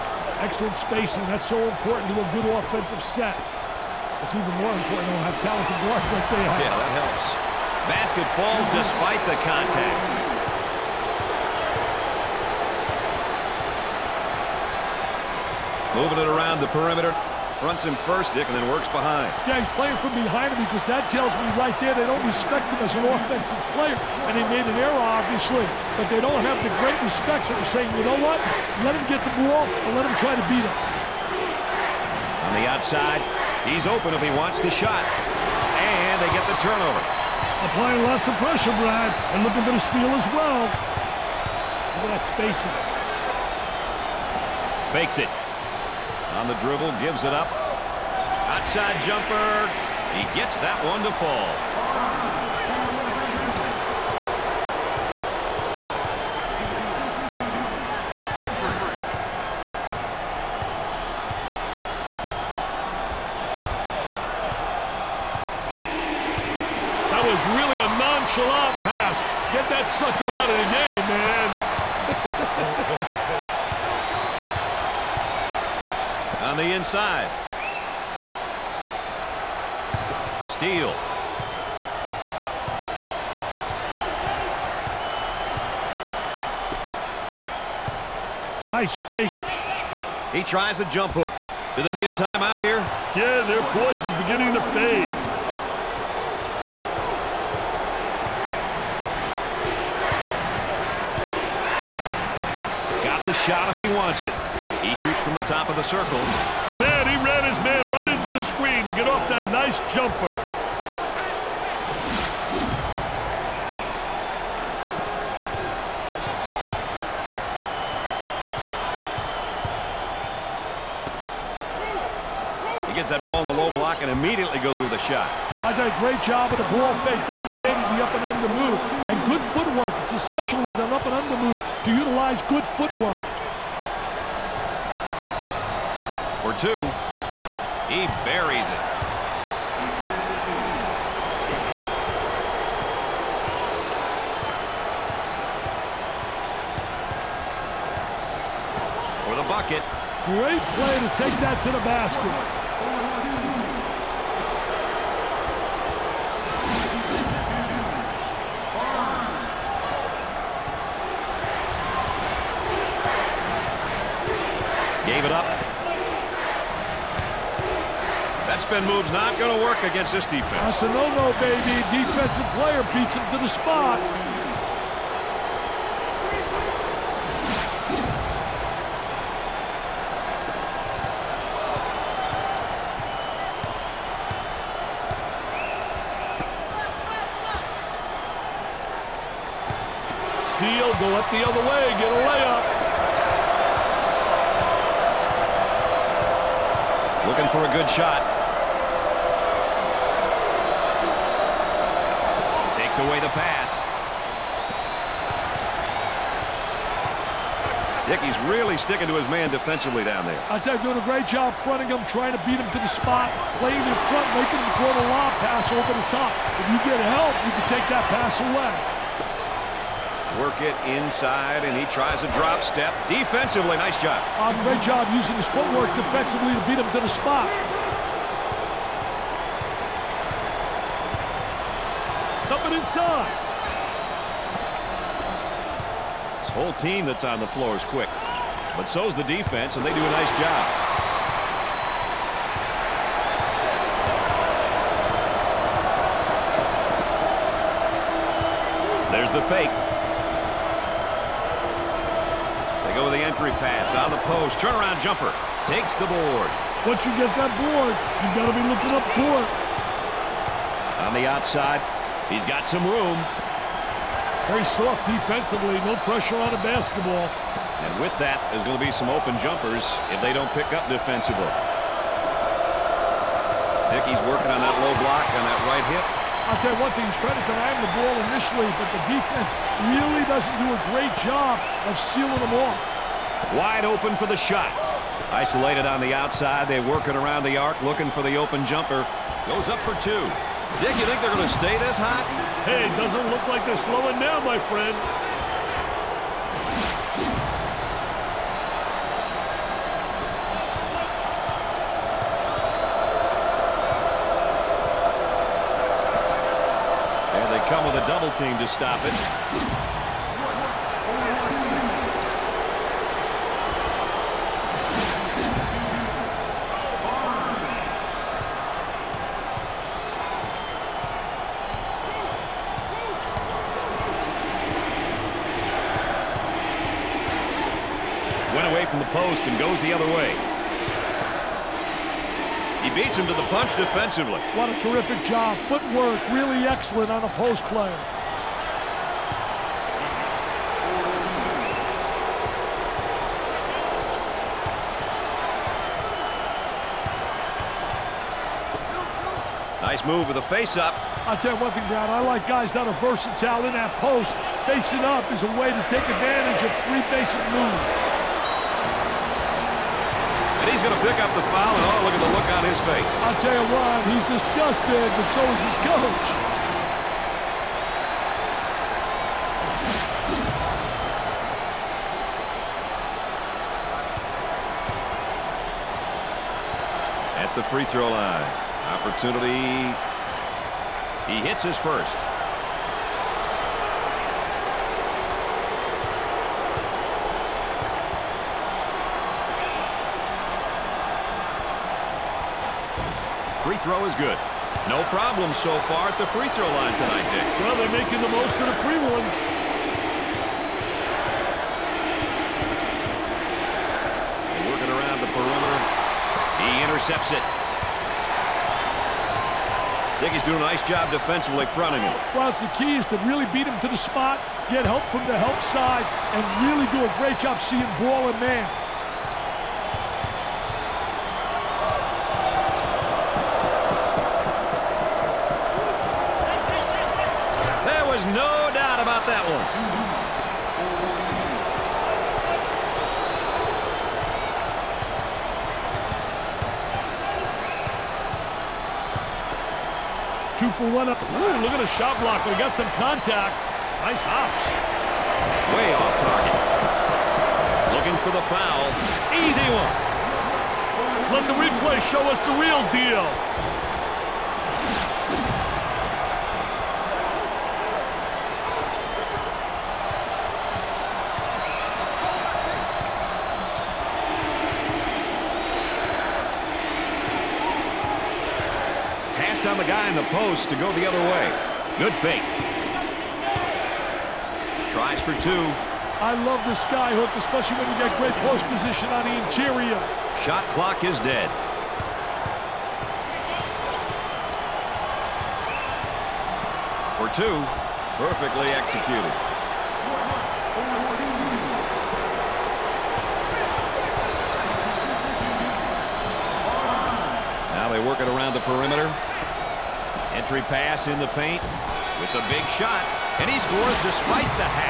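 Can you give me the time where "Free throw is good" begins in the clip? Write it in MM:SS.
06:33.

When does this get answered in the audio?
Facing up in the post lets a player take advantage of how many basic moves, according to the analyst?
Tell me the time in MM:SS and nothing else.
05:56.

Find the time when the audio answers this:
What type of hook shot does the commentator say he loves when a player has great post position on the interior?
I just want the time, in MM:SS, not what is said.
07:56.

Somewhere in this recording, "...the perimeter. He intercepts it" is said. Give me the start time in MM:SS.
06:45.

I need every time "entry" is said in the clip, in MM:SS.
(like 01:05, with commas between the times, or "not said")
04:13, 08:20.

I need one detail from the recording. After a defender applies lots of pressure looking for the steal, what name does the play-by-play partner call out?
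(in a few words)
Brad.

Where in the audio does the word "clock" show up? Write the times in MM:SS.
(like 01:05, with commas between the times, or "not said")
08:00.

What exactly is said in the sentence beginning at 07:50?
behind the post to go the other way.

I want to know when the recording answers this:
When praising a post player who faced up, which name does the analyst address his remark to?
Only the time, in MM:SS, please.
05:51.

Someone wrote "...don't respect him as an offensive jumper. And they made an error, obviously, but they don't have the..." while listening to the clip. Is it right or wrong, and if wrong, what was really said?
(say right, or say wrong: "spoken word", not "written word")
wrong: "player", not "jumper".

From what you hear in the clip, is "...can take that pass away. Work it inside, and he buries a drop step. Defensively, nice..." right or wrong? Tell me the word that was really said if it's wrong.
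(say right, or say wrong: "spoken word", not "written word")
wrong: "tries", not "buries".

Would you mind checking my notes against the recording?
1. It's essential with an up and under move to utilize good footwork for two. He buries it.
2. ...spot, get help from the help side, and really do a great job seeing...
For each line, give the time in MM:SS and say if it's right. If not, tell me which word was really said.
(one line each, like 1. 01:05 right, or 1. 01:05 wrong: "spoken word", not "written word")
1. 02:10 right
2. 06:53 right.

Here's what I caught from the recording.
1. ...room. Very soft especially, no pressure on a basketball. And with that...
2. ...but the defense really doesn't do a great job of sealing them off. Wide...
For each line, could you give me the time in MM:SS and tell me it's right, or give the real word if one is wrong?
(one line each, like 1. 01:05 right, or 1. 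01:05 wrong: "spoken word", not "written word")
1. 04:22 wrong: "defensively", not "especially"
2. 04:38 right.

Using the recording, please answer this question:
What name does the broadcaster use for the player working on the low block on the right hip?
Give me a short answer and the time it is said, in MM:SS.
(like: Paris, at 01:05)
Hickey, at 04:33.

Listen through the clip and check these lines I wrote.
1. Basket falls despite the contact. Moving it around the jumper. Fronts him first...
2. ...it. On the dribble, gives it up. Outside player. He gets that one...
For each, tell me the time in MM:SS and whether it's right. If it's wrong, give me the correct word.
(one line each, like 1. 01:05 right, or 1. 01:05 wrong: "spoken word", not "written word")
1. 00:07 wrong: "perimeter", not "jumper"
2. 00:45 wrong: "jumper", not "player".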